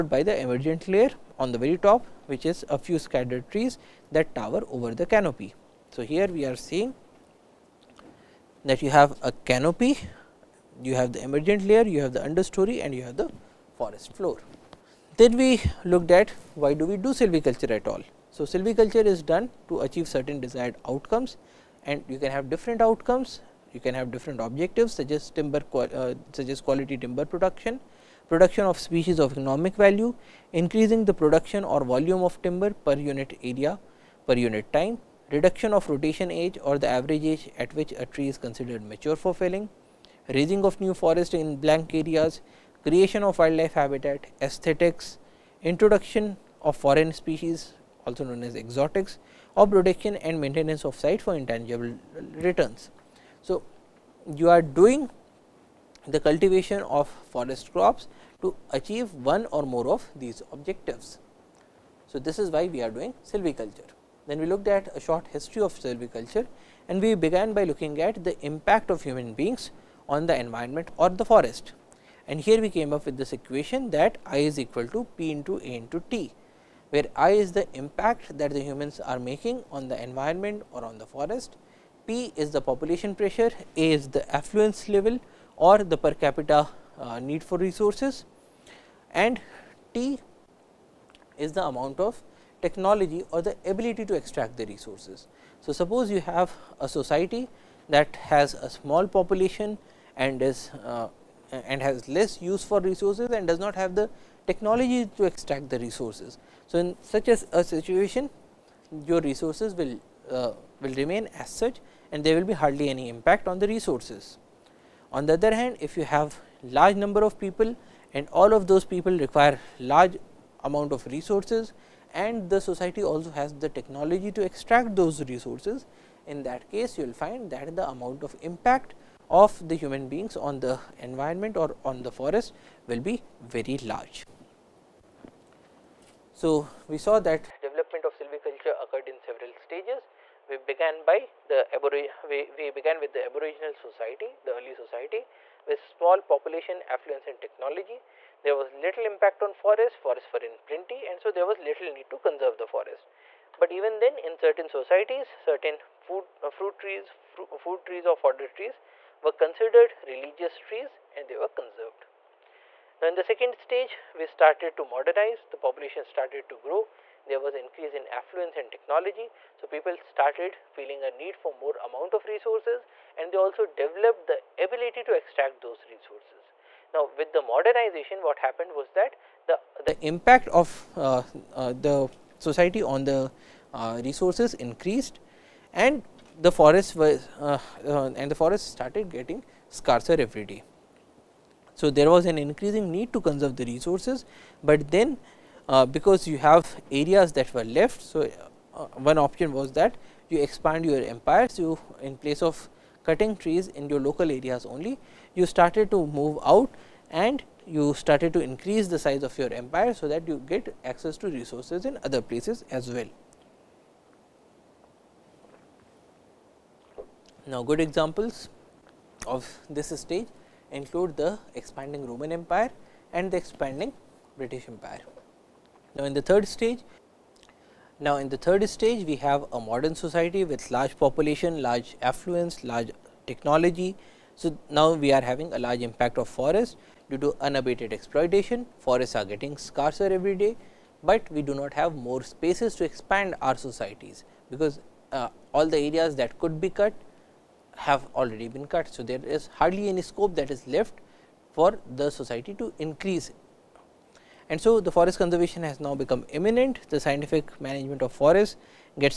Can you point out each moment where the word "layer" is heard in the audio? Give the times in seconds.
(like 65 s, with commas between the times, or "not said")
0 s, 11 s.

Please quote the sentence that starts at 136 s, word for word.
So, we saw that development of silviculture occurred in several stages.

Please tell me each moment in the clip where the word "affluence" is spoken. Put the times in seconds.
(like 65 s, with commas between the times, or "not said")
84 s, 146 s, 168 s, 232 s.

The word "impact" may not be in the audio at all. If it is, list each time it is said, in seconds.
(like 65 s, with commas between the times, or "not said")
68 s, 77 s, 113 s, 128 s, 149 s, 180 s, 235 s.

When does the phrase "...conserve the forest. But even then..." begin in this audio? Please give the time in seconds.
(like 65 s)
152 s.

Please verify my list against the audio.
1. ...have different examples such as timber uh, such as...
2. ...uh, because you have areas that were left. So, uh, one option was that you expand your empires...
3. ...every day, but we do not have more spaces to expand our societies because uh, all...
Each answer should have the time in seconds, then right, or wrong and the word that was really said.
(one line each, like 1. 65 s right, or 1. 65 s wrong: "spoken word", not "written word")
1. 23 s wrong: "objectives", not "examples"
2. 195 s right
3. 240 s right.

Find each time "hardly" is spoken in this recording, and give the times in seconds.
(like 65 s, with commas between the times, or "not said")
112 s, 249 s.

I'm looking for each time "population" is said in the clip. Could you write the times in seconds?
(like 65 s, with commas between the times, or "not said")
82 s, 99 s, 146 s, 165 s, 230 s.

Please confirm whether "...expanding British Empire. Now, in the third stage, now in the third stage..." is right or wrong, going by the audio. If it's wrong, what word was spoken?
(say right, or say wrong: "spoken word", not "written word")
right.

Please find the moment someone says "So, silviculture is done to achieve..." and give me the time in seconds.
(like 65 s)
18 s.